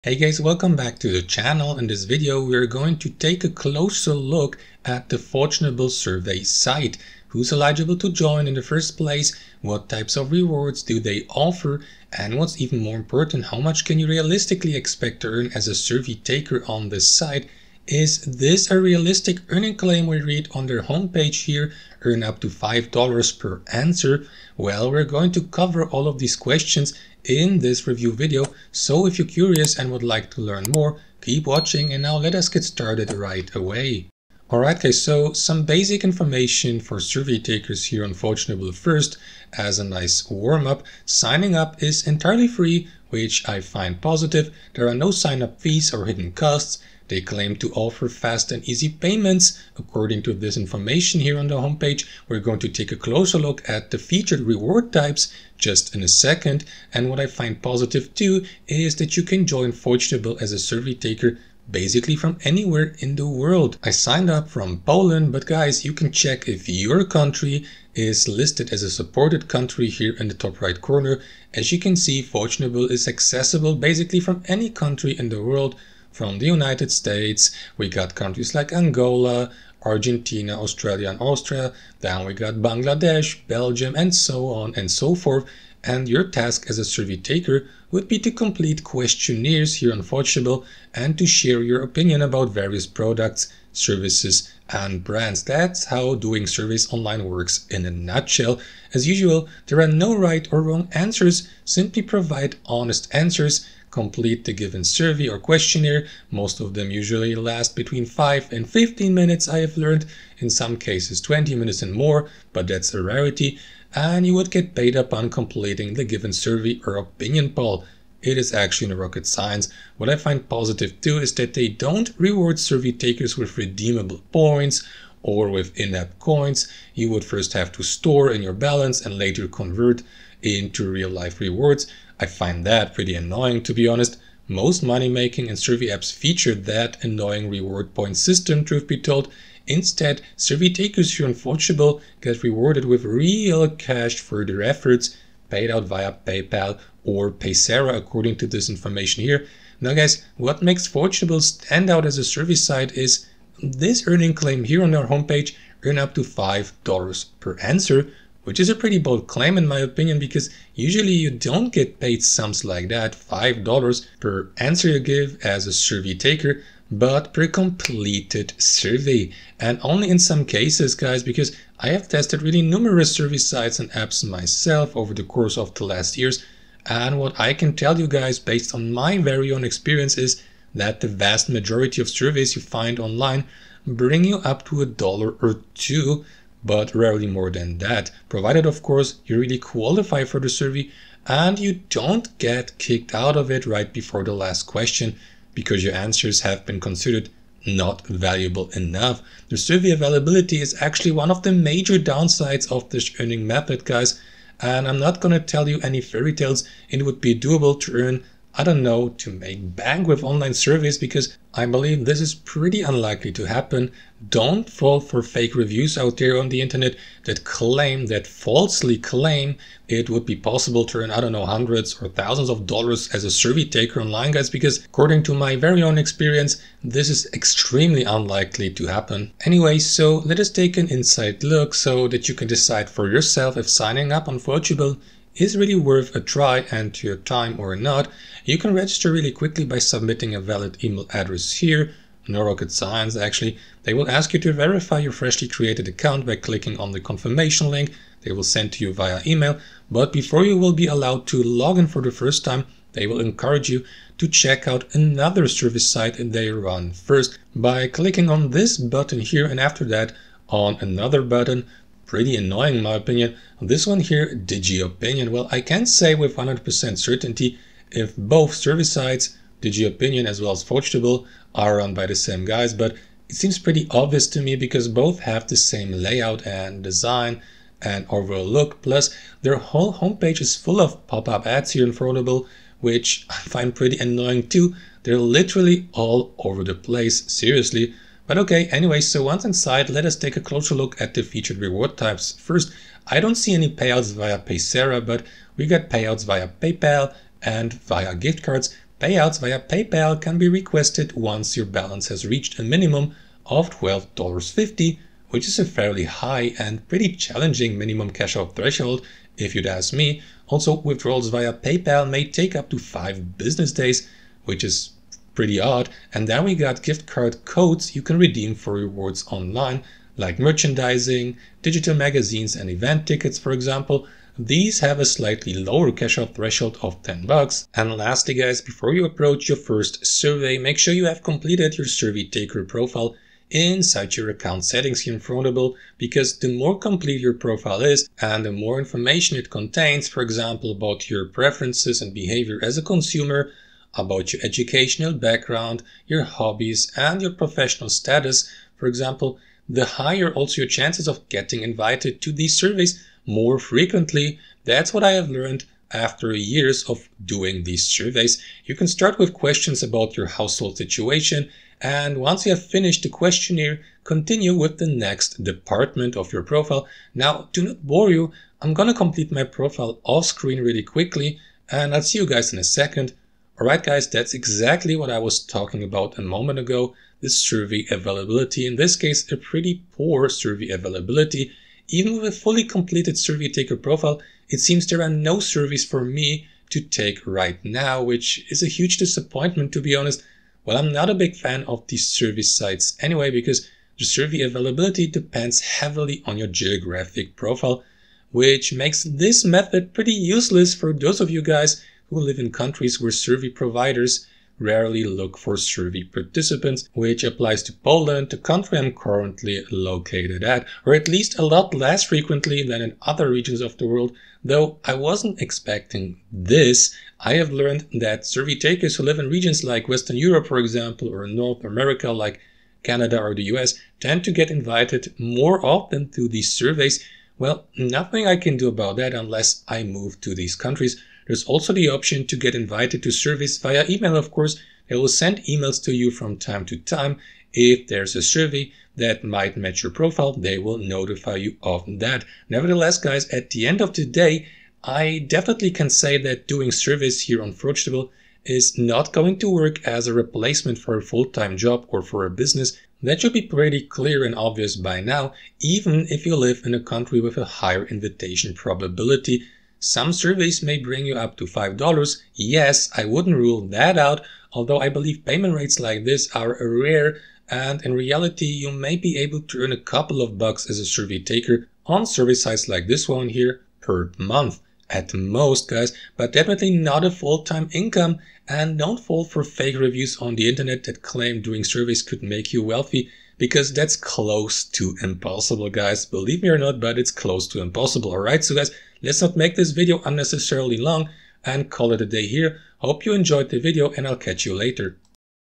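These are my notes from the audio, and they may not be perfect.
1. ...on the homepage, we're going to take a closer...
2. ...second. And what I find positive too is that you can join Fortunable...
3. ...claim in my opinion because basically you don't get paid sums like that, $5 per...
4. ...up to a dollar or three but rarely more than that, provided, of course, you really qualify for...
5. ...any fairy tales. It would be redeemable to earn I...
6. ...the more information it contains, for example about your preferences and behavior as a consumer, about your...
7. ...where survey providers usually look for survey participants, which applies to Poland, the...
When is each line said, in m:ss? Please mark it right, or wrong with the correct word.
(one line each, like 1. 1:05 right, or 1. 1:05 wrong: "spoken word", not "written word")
1. 0:51 right
2. 0:56 right
3. 2:39 wrong: "usually", not "basically"
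4. 3:04 wrong: "two", not "three"
5. 3:25 wrong: "doable", not "redeemable"
6. 5:38 right
7. 6:42 wrong: "rarely", not "usually".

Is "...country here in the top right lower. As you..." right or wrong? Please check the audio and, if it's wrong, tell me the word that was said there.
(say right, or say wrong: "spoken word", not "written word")
wrong: "corner", not "lower".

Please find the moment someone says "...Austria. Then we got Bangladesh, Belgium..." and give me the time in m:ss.
1:21.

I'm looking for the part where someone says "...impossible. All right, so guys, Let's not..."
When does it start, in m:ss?
8:07.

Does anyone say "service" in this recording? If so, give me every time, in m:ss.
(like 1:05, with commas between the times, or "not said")
1:33, 4:15, 4:28.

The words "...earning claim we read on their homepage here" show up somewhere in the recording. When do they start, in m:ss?
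0:19.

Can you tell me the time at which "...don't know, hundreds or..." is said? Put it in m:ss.
3:41.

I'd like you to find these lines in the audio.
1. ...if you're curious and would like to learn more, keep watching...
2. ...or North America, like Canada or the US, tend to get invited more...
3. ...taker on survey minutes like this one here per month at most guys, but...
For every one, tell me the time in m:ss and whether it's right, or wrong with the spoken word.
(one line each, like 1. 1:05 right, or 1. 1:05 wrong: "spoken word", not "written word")
1. 0:29 right
2. 7:01 right
3. 7:51 wrong: "sites", not "minutes".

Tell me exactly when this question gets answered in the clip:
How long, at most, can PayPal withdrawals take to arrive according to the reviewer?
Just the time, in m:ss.
5:12.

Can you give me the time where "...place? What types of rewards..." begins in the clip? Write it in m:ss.
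0:08.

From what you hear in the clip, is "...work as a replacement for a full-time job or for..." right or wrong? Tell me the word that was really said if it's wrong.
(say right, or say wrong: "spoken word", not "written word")
right.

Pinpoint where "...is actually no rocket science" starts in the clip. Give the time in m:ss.
1:58.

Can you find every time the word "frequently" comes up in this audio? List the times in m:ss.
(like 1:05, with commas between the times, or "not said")
5:53, 6:52.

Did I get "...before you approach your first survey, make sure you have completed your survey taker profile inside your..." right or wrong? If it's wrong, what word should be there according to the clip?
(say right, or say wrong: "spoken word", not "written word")
right.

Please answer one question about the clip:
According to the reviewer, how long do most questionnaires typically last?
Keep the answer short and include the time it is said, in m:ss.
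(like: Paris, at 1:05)
5 to 15 minutes, at 1:47.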